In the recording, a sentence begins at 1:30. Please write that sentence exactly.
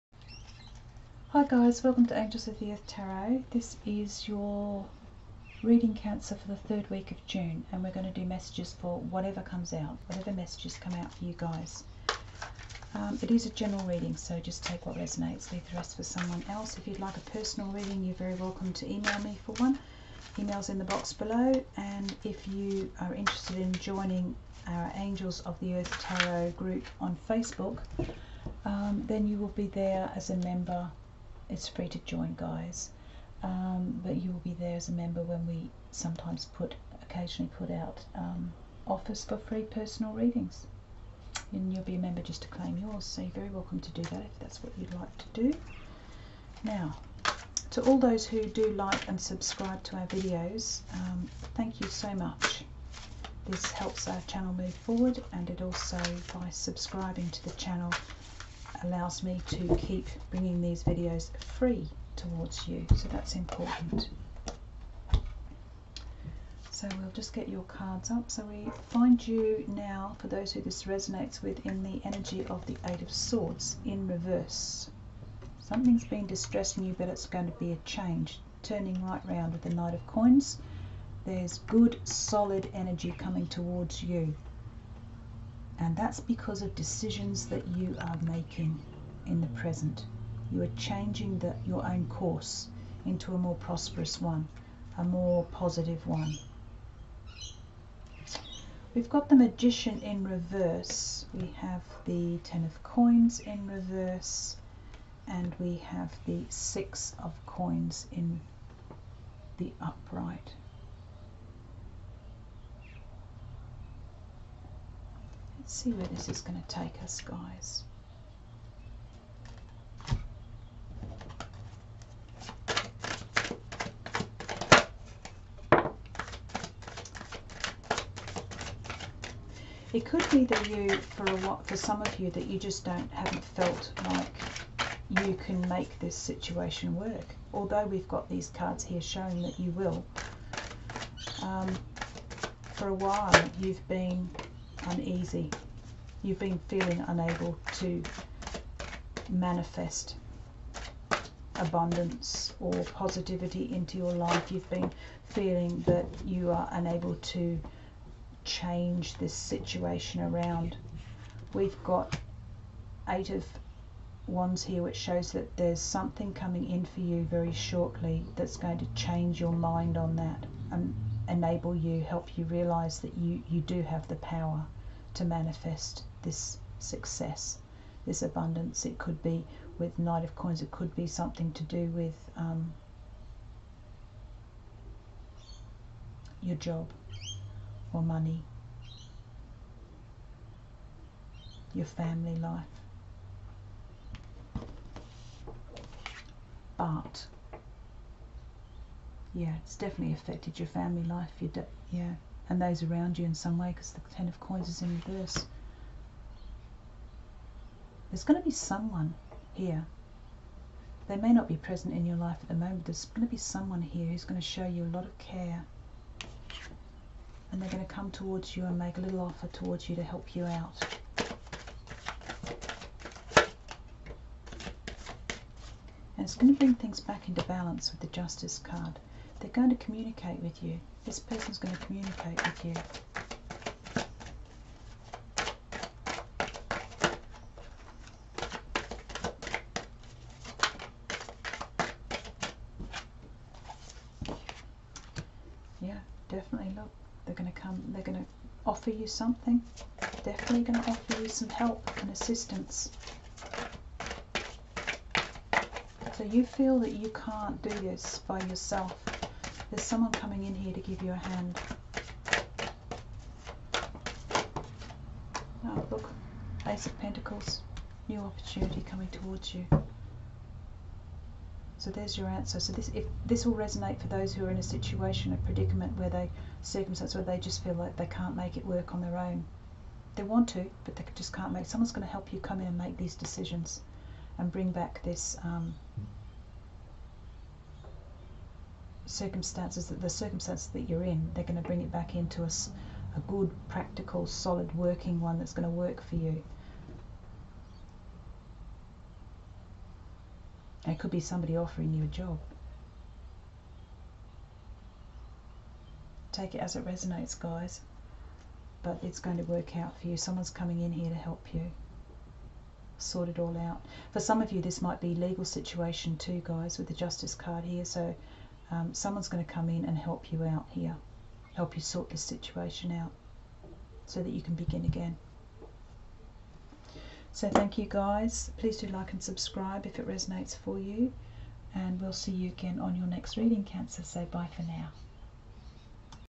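You are changing the, your own course into a more prosperous one, a more positive one.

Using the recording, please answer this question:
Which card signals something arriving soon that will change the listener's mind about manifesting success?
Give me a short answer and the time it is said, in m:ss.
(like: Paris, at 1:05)
Eight of Wands, at 2:43.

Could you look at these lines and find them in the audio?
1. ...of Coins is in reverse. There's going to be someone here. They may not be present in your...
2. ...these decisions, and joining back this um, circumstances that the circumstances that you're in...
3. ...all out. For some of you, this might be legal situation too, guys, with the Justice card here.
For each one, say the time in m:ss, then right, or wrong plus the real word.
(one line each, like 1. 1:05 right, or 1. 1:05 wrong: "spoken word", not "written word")
1. 3:24 right
2. 4:42 wrong: "bring", not "joining"
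3. 5:13 right.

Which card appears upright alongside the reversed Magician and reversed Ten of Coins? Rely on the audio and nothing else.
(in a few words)
Six of Coins.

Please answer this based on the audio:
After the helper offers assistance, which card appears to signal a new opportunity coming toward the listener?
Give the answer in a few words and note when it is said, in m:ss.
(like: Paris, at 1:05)
Ace of Pentacles, at 4:26.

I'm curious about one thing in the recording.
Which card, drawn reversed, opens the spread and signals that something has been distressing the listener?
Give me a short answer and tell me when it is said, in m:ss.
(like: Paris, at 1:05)
Eight of Swords, at 1:12.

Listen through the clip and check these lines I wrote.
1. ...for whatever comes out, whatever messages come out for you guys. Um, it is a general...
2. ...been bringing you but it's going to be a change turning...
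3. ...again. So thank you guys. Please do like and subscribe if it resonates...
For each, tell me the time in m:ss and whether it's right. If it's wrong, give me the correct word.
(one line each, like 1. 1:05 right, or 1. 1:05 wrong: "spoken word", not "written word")
1. 0:08 right
2. 1:16 wrong: "distressing", not "bringing"
3. 5:24 right.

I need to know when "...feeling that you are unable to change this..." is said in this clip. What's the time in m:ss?
2:35.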